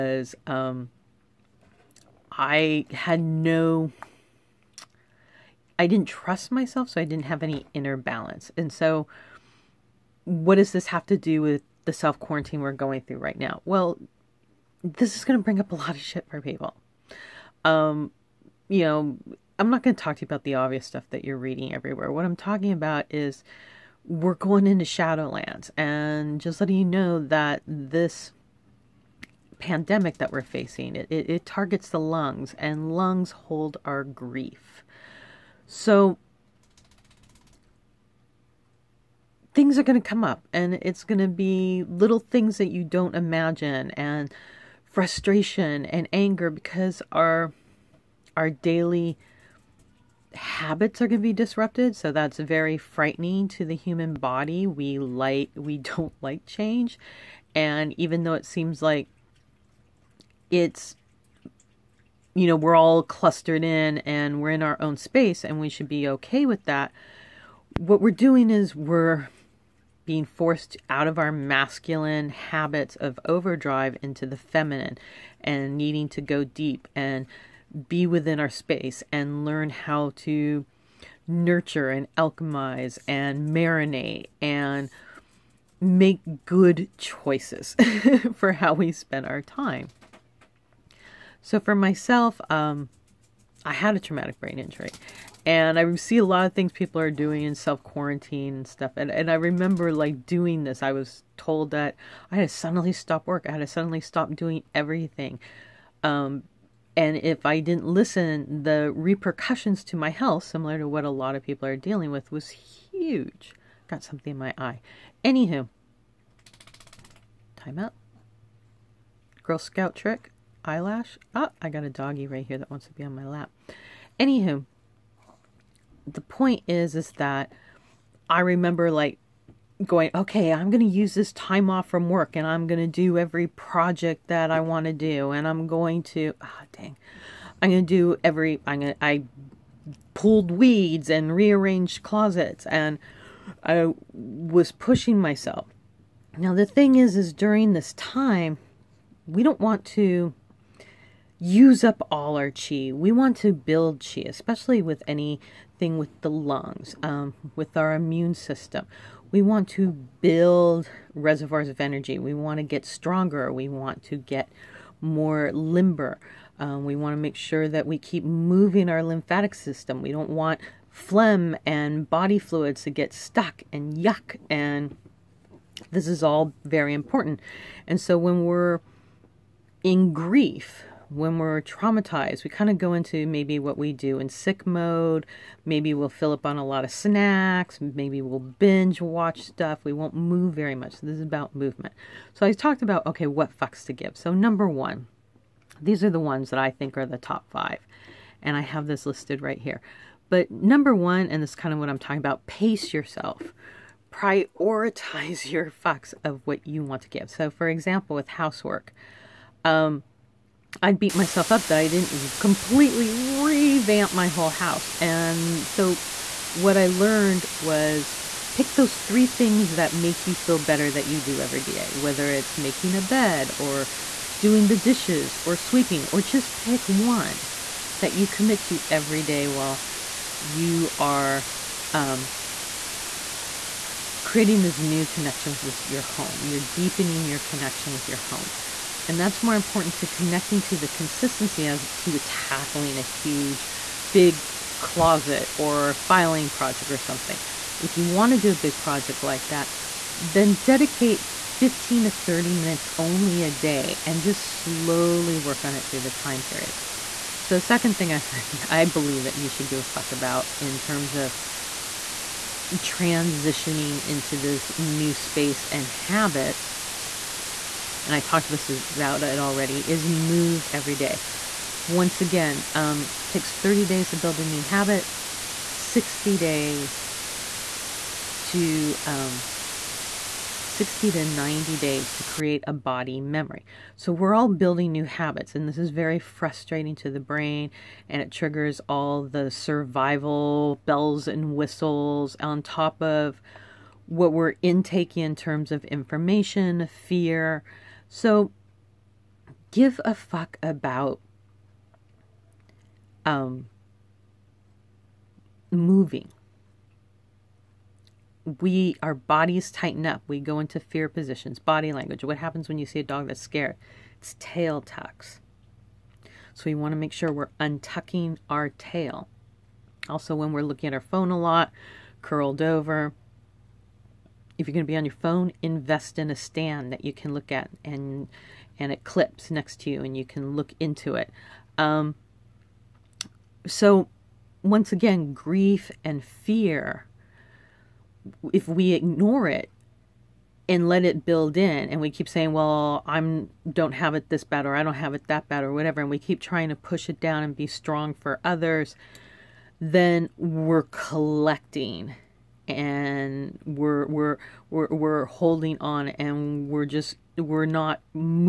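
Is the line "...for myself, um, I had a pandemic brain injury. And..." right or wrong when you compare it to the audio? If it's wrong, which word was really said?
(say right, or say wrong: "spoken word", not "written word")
wrong: "traumatic", not "pandemic".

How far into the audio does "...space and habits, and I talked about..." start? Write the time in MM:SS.
04:25.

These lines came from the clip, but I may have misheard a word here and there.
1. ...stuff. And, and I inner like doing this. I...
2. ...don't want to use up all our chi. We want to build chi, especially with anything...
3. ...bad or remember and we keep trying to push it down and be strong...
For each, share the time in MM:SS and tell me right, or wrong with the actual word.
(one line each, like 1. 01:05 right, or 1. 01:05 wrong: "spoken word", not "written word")
1. 01:38 wrong: "remember", not "inner"
2. 02:29 right
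3. 05:45 wrong: "whatever", not "remember".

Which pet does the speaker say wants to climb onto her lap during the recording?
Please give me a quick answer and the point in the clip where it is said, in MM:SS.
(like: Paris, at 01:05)
Doggy, at 02:01.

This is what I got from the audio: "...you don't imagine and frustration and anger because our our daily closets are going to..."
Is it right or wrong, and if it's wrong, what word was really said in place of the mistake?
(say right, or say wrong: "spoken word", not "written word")
wrong: "habits", not "closets".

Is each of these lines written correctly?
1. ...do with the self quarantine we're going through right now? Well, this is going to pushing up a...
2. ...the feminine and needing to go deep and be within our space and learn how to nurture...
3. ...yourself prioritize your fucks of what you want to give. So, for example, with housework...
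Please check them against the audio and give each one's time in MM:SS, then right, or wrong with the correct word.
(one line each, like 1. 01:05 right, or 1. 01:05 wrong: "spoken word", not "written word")
1. 00:11 wrong: "bring", not "pushing"
2. 01:14 right
3. 03:22 right.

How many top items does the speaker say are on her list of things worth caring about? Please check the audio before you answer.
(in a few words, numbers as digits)
5.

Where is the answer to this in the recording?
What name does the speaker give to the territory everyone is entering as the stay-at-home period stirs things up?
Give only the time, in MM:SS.
00:24.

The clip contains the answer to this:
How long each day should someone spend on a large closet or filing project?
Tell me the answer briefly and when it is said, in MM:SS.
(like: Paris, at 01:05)
15 to 30 minutes, at 04:11.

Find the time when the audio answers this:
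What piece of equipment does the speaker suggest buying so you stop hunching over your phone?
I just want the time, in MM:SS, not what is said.
05:26.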